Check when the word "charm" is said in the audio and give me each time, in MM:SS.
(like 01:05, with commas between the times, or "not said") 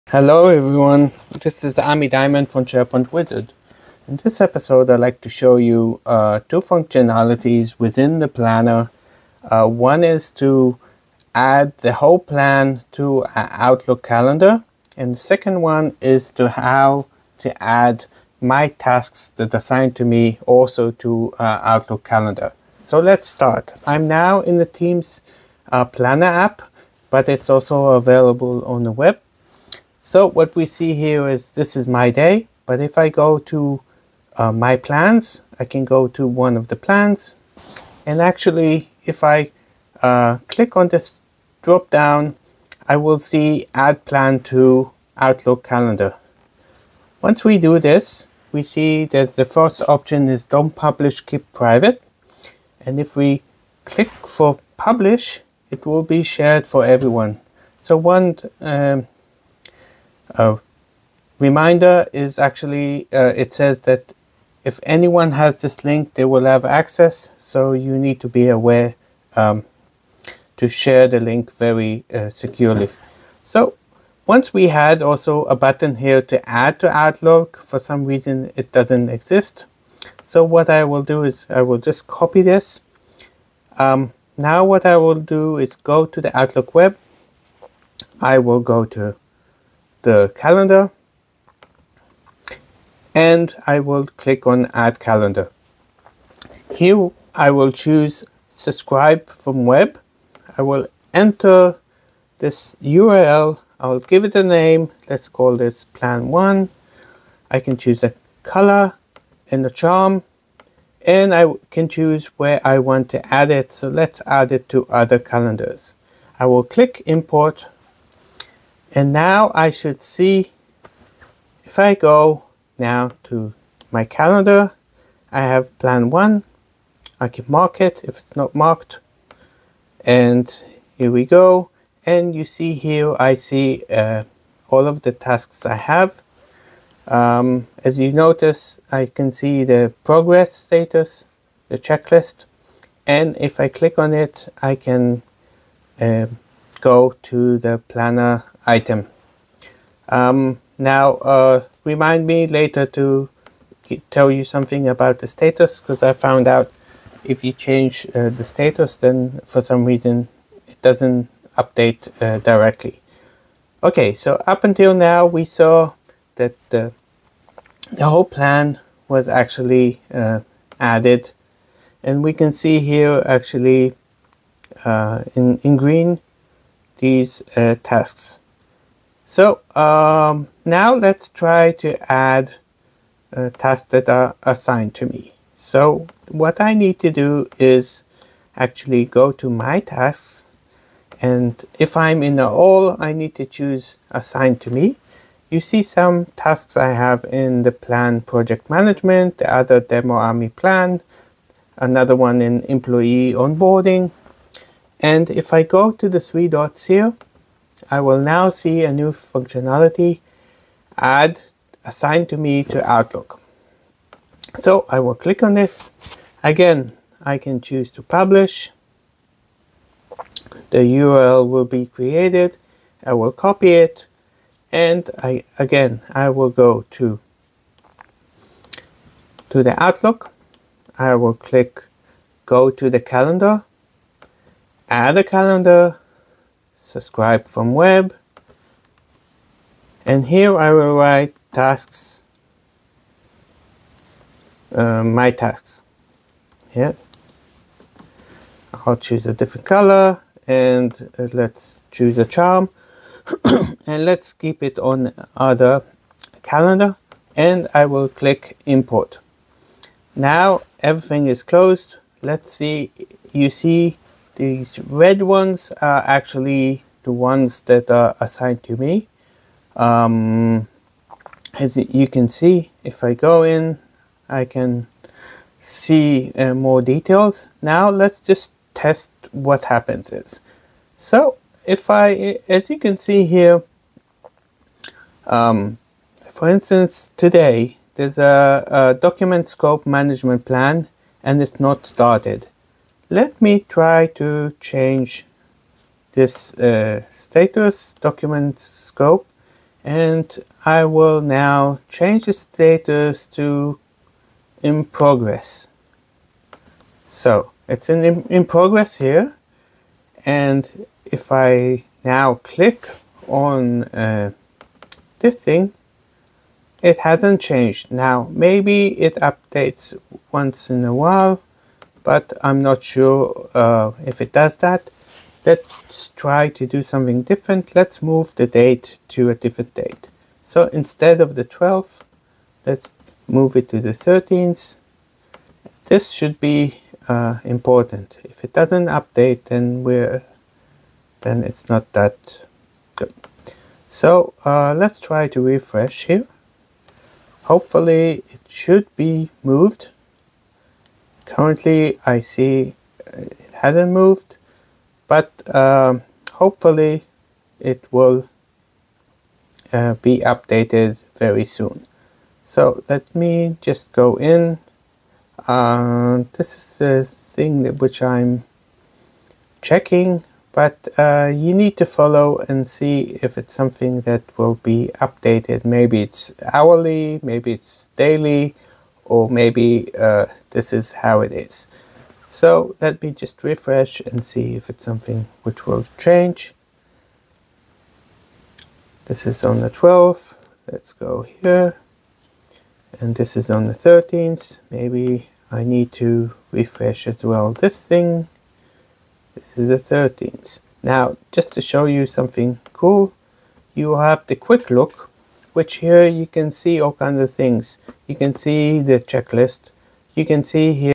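01:49, 04:12.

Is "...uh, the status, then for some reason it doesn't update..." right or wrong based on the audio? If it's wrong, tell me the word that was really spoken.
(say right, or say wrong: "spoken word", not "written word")
right.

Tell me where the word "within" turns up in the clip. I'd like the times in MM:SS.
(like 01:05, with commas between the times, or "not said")
00:07.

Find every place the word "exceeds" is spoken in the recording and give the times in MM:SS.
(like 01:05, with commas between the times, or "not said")
not said.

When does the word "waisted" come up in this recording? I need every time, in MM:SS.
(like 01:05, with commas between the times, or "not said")
not said.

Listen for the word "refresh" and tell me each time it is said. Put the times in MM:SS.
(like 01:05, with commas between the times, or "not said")
05:45, 06:23, 06:36.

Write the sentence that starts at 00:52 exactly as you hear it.
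And if we click for publish, it will be shared for everyone.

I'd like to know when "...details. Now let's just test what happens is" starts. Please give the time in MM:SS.
04:36.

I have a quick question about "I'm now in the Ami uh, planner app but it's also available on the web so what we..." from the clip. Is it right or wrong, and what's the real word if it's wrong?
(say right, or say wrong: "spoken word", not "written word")
wrong: "Teams", not "Ami".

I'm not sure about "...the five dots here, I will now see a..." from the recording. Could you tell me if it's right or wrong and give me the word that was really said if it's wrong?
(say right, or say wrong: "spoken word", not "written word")
wrong: "three", not "five".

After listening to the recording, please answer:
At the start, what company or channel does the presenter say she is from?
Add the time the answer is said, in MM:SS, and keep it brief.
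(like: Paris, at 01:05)
SharePoint Wizard, at 00:02.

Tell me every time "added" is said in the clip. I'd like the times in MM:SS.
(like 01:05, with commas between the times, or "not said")
02:50.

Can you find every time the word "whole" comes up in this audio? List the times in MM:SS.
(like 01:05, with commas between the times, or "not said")
00:11, 02:48.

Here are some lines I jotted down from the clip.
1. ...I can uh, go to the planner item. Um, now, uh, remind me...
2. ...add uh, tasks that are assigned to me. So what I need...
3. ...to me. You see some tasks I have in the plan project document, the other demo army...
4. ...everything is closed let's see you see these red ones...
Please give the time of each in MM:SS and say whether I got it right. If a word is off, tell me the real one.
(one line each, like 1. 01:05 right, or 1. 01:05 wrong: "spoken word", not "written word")
1. 02:24 right
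2. 03:02 right
3. 03:14 wrong: "management", not "document"
4. 04:20 right.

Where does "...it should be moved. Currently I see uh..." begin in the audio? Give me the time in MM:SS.
05:48.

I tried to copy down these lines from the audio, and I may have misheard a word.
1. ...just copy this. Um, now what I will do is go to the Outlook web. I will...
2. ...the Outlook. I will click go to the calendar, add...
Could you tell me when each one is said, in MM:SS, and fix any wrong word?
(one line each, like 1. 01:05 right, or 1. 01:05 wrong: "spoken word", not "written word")
1. 01:21 right
2. 03:49 right.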